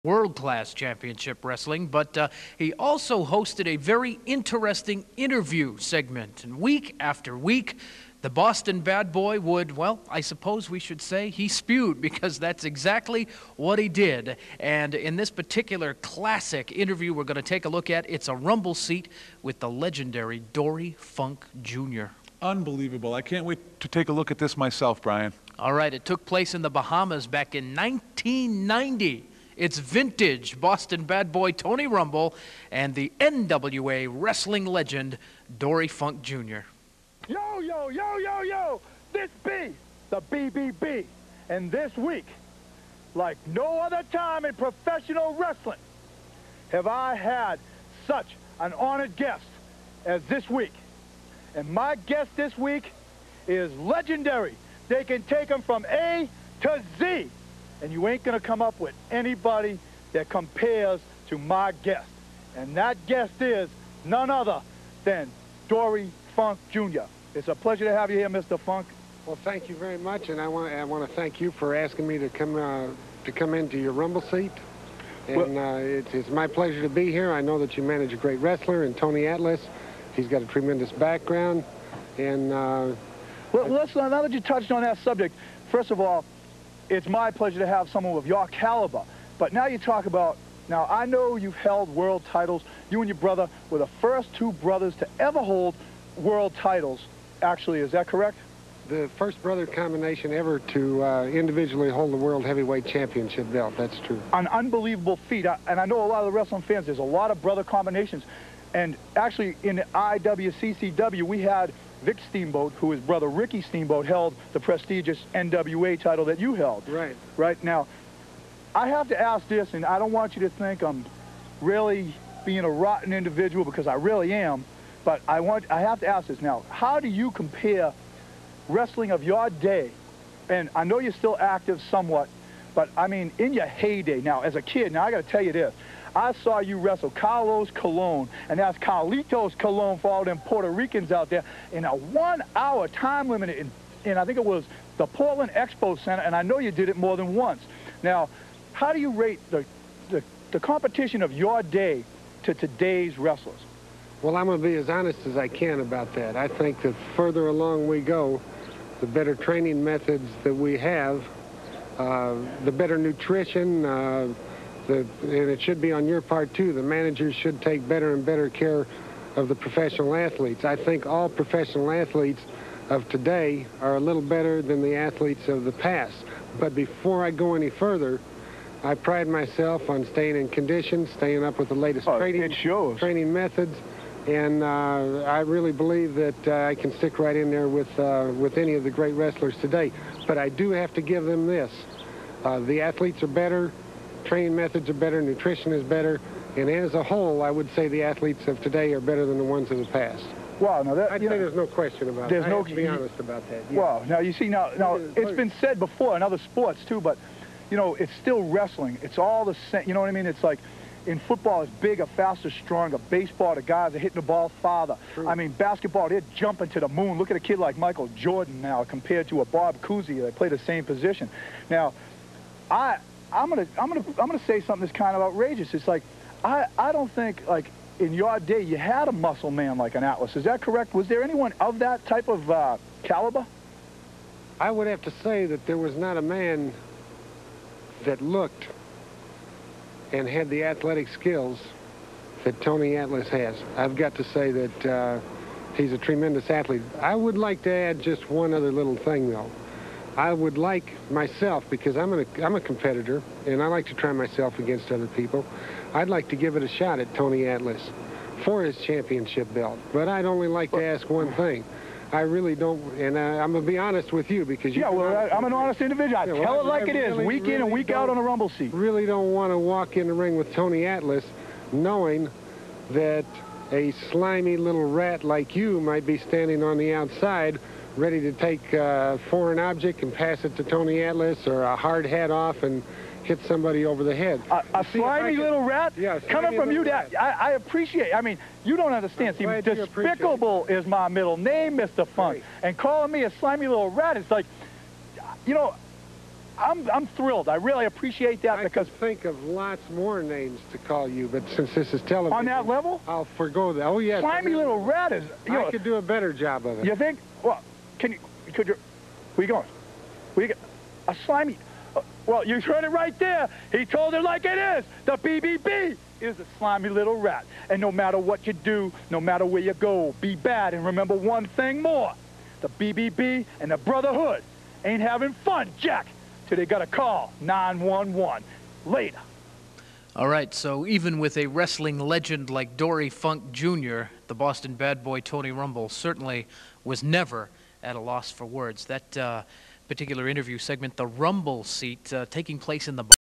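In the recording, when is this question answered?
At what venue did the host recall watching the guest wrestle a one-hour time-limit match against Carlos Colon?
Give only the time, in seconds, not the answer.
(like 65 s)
145 s.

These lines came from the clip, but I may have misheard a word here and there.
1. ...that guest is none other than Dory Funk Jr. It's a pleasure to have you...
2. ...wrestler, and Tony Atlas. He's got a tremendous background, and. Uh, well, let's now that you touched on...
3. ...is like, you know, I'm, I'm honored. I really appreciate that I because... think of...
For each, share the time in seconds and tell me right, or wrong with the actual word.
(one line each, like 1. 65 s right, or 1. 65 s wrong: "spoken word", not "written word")
1. 62 s right
2. 78 s right
3. 294 s wrong: "thrilled", not "honored".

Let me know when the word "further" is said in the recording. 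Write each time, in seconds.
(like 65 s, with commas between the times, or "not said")
157 s, 177 s.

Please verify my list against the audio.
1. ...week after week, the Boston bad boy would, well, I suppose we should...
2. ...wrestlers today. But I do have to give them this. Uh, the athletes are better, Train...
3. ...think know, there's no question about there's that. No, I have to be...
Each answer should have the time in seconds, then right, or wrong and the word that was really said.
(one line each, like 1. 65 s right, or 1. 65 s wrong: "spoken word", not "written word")
1. 6 s right
2. 189 s right
3. 201 s right.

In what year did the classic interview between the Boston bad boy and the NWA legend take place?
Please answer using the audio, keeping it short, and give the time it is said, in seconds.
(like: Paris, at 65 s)
1990, at 27 s.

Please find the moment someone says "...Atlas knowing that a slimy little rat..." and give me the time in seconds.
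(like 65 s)
270 s.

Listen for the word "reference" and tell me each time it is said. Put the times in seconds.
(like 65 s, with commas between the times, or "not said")
not said.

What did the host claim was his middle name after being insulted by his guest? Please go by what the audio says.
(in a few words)
Despicable.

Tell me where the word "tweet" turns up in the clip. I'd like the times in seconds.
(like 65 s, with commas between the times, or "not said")
not said.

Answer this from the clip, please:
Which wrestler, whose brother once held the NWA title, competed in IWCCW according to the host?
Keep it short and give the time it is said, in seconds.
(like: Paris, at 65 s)
Vic Steamboat, at 112 s.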